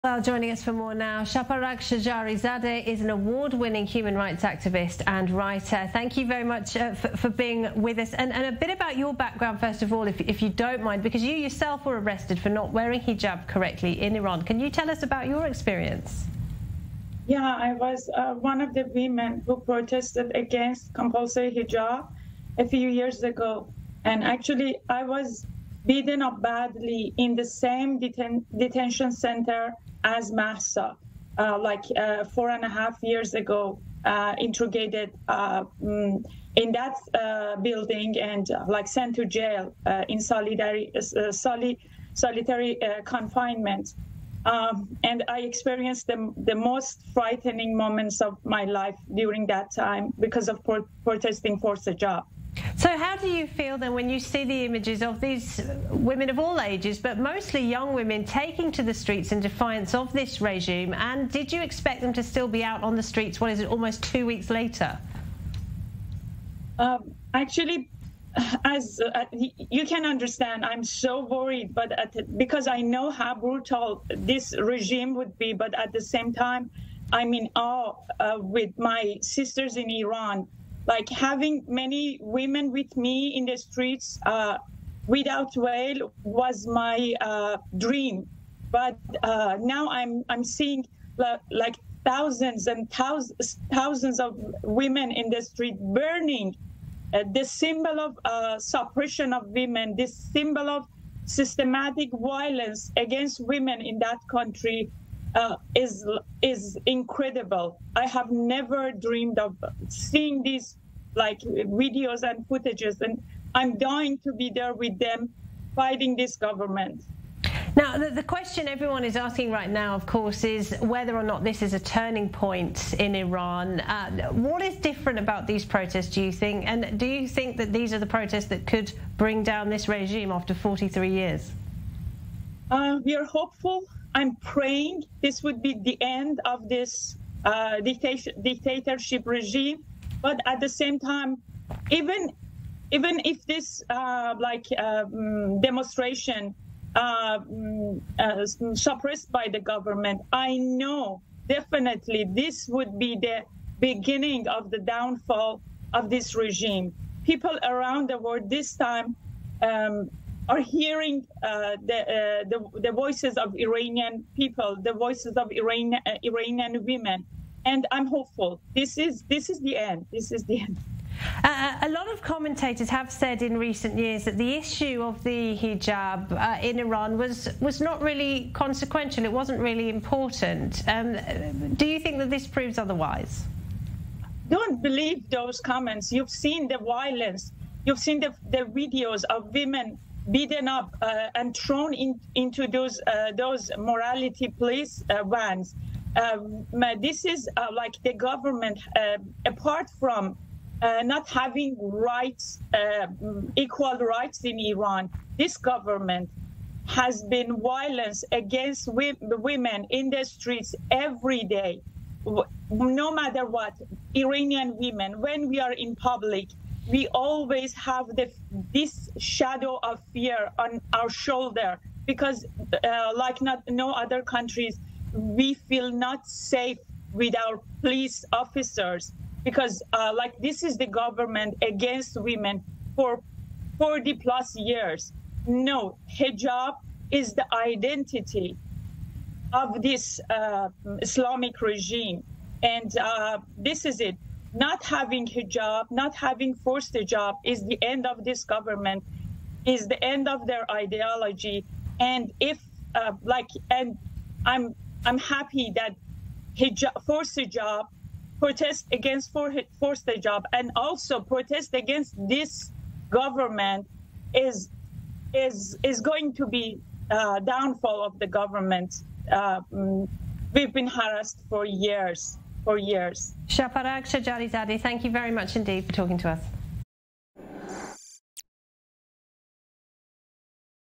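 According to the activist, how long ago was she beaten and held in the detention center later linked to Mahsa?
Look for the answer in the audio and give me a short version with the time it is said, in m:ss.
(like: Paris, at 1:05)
4.5 years, at 0:32.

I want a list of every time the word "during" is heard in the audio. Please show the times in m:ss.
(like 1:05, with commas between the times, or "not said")
0:49.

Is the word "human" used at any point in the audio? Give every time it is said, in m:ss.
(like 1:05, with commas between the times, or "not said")
0:03.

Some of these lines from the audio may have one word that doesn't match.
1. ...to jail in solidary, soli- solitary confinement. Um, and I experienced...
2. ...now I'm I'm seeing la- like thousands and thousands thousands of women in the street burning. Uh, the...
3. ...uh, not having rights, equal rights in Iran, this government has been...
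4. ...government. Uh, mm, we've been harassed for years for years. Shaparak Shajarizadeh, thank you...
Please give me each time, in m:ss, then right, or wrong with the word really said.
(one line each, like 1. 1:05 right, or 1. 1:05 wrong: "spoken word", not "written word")
1. 0:39 right
2. 1:29 right
3. 3:20 right
4. 4:28 right.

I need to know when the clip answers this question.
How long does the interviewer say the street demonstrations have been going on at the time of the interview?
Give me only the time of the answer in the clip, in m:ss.
1:03.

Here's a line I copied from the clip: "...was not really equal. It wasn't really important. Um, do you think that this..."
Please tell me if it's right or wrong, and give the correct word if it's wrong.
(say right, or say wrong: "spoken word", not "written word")
wrong: "consequential", not "equal".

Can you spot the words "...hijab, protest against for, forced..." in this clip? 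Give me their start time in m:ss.
4:17.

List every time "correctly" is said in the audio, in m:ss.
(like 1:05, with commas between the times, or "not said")
0:13.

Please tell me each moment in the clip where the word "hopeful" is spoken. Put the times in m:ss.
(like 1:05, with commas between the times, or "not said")
2:13, 2:48.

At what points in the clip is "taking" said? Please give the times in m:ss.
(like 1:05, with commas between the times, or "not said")
0:58.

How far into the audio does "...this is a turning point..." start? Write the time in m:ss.
2:01.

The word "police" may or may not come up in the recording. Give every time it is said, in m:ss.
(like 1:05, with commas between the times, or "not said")
3:14, 3:47.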